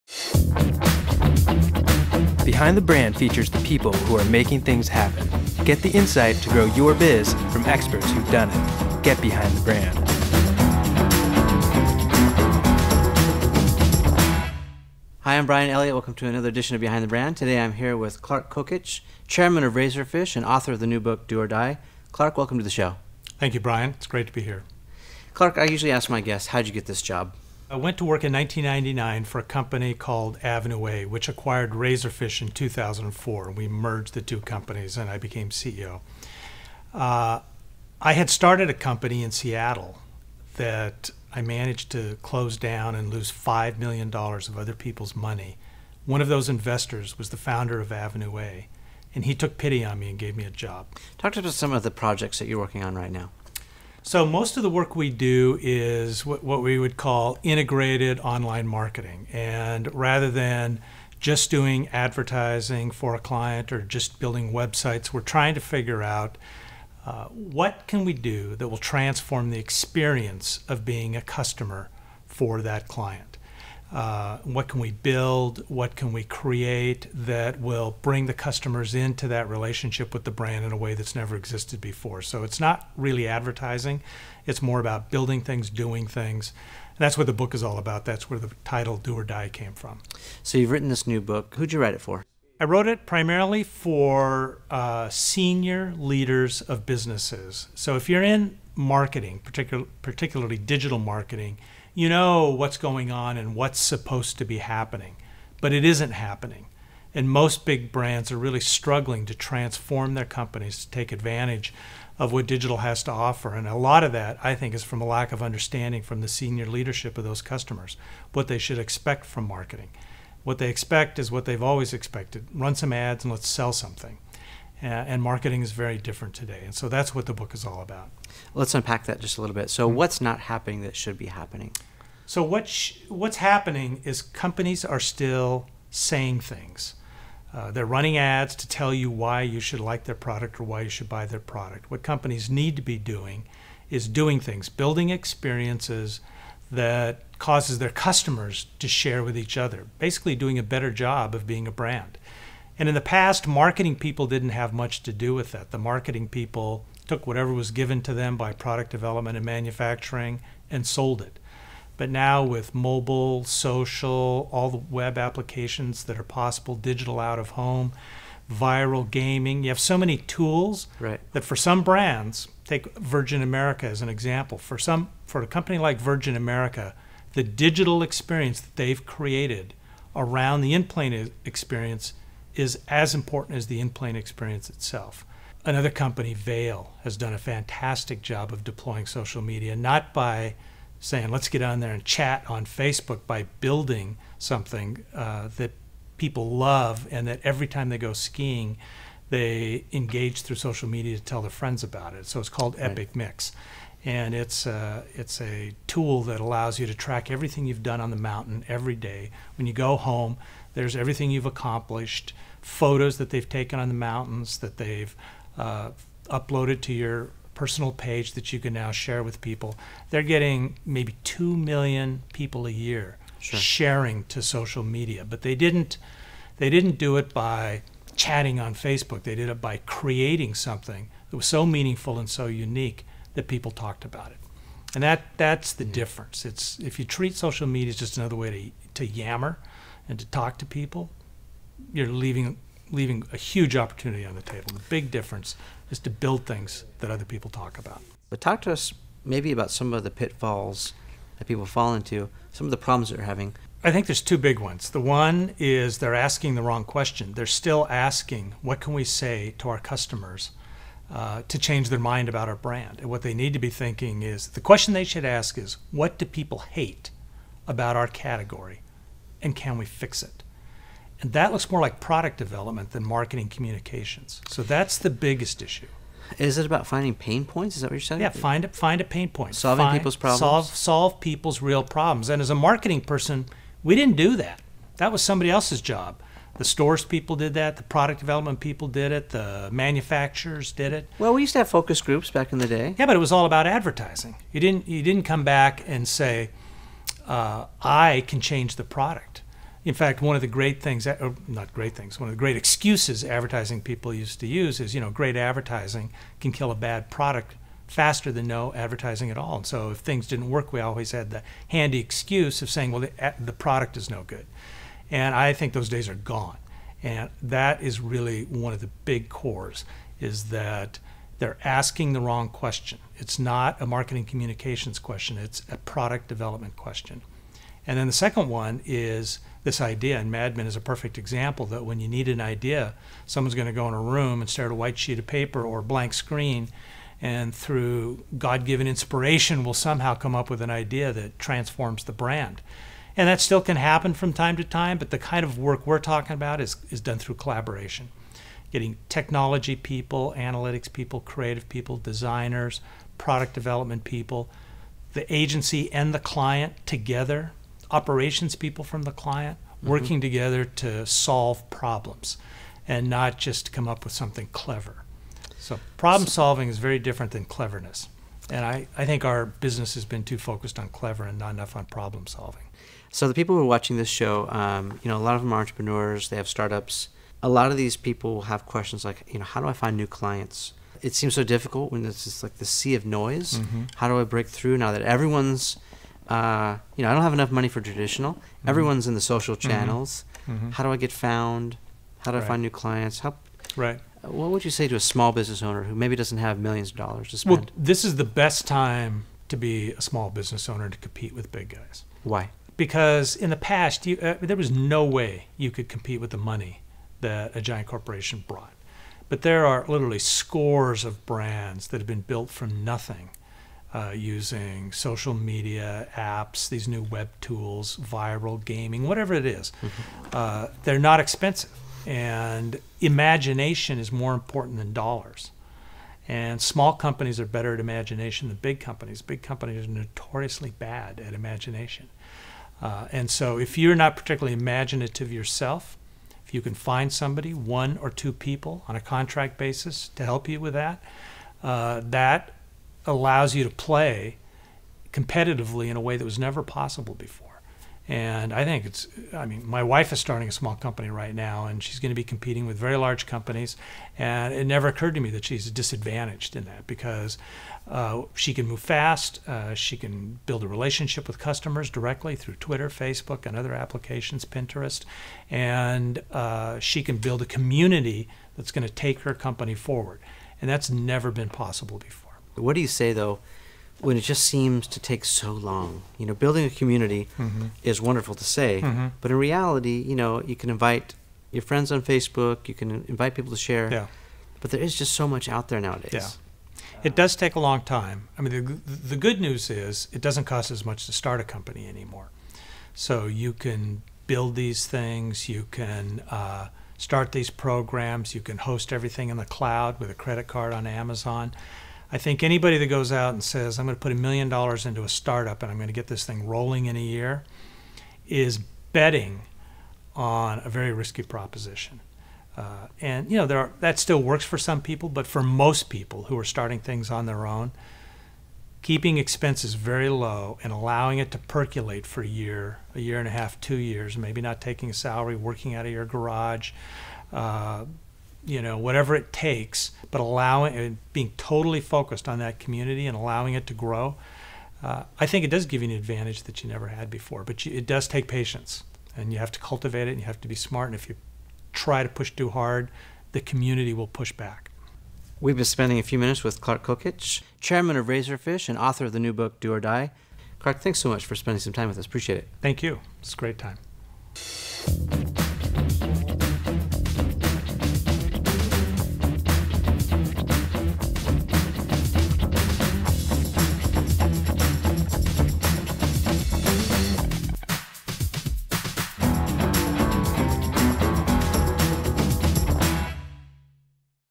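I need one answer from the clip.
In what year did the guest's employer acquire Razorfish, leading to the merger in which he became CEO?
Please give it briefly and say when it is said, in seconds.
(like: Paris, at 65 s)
2004, at 32 s.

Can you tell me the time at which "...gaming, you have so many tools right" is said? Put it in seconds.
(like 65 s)
169 s.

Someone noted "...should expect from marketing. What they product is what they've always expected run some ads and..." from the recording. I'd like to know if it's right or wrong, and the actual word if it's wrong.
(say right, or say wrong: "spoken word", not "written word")
wrong: "expect", not "product".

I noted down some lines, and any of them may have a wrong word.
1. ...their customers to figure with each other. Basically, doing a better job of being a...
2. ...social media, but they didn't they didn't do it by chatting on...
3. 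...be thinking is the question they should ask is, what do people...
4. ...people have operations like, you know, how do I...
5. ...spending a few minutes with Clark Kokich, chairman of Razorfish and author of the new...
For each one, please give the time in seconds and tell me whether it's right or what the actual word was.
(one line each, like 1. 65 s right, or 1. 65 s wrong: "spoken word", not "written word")
1. 147 s wrong: "share", not "figure"
2. 224 s right
3. 263 s right
4. 377 s wrong: "questions", not "operations"
5. 545 s right.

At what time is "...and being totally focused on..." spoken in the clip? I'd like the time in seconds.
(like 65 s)
530 s.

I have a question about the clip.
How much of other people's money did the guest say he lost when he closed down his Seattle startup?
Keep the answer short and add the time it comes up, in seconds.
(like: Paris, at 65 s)
$5 million, at 43 s.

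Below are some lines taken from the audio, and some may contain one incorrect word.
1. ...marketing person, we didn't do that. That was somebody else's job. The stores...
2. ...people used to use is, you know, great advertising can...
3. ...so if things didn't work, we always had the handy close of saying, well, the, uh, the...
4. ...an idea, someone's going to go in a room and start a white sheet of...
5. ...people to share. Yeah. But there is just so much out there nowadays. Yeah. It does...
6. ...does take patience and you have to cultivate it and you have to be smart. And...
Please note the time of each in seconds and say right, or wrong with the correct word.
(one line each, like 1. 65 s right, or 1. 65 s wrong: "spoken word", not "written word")
1. 282 s right
2. 303 s right
3. 309 s wrong: "excuse", not "close"
4. 332 s right
5. 483 s right
6. 537 s right.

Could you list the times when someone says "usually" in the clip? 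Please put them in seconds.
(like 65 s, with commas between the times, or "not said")
25 s.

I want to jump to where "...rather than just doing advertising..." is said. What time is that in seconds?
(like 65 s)
59 s.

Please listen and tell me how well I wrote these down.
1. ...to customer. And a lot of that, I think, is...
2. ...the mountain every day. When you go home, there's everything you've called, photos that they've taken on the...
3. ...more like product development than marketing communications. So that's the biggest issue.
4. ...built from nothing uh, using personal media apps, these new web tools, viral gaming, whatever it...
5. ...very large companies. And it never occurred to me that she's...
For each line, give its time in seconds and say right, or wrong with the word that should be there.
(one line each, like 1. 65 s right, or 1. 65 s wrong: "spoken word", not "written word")
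1. 113 s wrong: "offer", not "customer"
2. 208 s wrong: "accomplished", not "called"
3. 271 s right
4. 412 s wrong: "social", not "personal"
5. 452 s right.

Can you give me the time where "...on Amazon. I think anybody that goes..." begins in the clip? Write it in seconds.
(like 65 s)
500 s.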